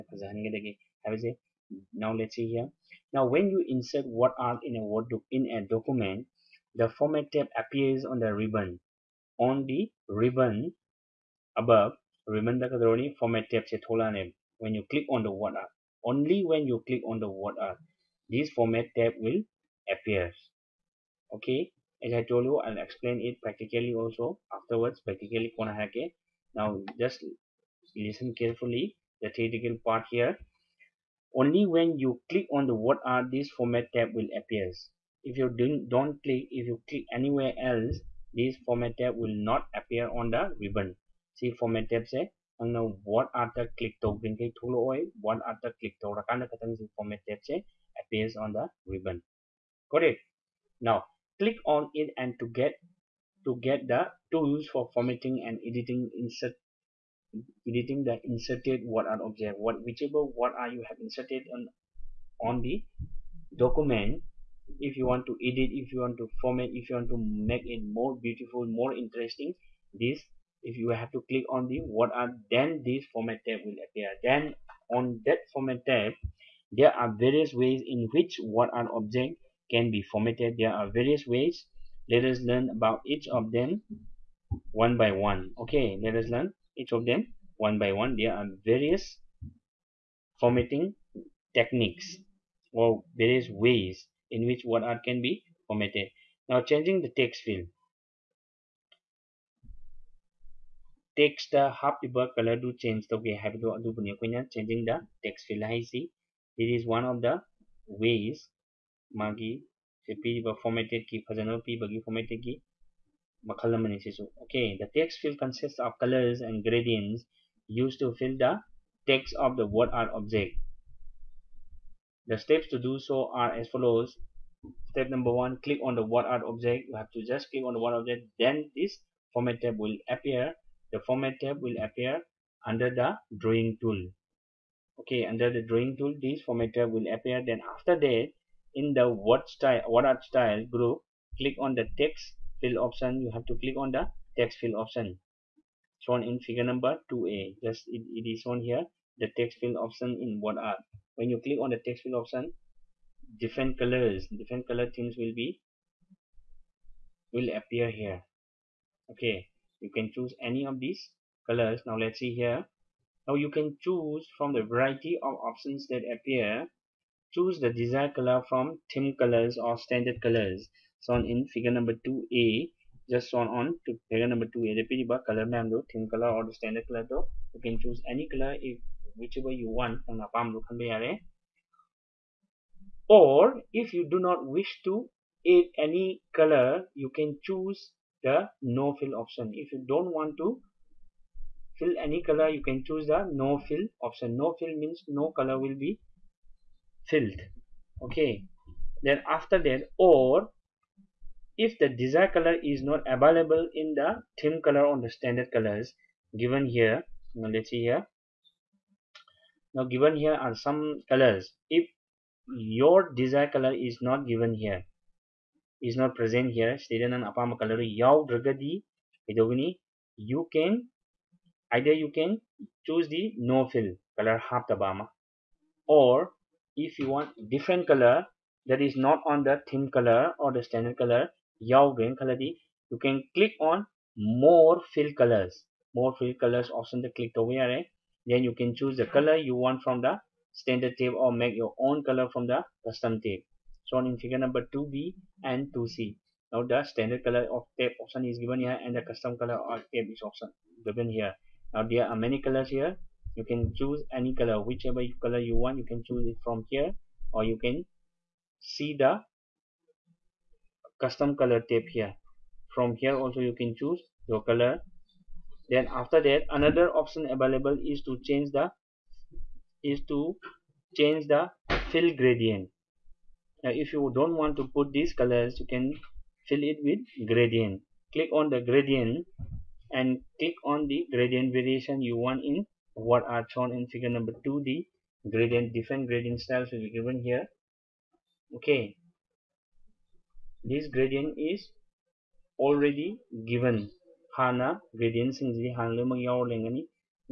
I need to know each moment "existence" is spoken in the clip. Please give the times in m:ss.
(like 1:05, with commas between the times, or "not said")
not said.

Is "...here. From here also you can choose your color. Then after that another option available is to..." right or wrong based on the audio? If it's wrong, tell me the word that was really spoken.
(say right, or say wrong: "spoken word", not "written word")
right.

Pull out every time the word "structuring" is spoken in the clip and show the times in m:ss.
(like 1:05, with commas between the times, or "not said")
not said.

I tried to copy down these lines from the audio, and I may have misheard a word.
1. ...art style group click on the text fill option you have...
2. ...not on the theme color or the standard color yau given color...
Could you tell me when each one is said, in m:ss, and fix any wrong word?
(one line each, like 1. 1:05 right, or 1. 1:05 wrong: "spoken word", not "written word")
1. 2:20 right
2. 3:48 wrong: "green", not "given".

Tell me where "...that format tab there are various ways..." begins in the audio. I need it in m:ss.
1:15.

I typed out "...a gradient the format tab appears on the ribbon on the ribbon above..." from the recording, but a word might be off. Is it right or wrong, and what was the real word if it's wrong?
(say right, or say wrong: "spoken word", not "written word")
wrong: "document", not "gradient".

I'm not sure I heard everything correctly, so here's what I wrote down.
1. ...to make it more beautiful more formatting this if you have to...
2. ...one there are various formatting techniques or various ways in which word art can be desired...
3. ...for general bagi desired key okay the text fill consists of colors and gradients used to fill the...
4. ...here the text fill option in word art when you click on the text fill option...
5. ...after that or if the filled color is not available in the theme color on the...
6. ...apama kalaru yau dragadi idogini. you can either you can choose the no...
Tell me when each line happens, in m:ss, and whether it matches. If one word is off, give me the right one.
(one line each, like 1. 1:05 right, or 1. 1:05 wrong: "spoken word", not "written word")
1. 1:07 wrong: "interesting", not "formatting"
2. 1:27 wrong: "formatted", not "desired"
3. 1:51 wrong: "formatted", not "desired"
4. 2:28 right
5. 3:19 wrong: "desired", not "filled"
6. 3:37 right.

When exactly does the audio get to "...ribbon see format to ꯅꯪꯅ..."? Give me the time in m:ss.
0:40.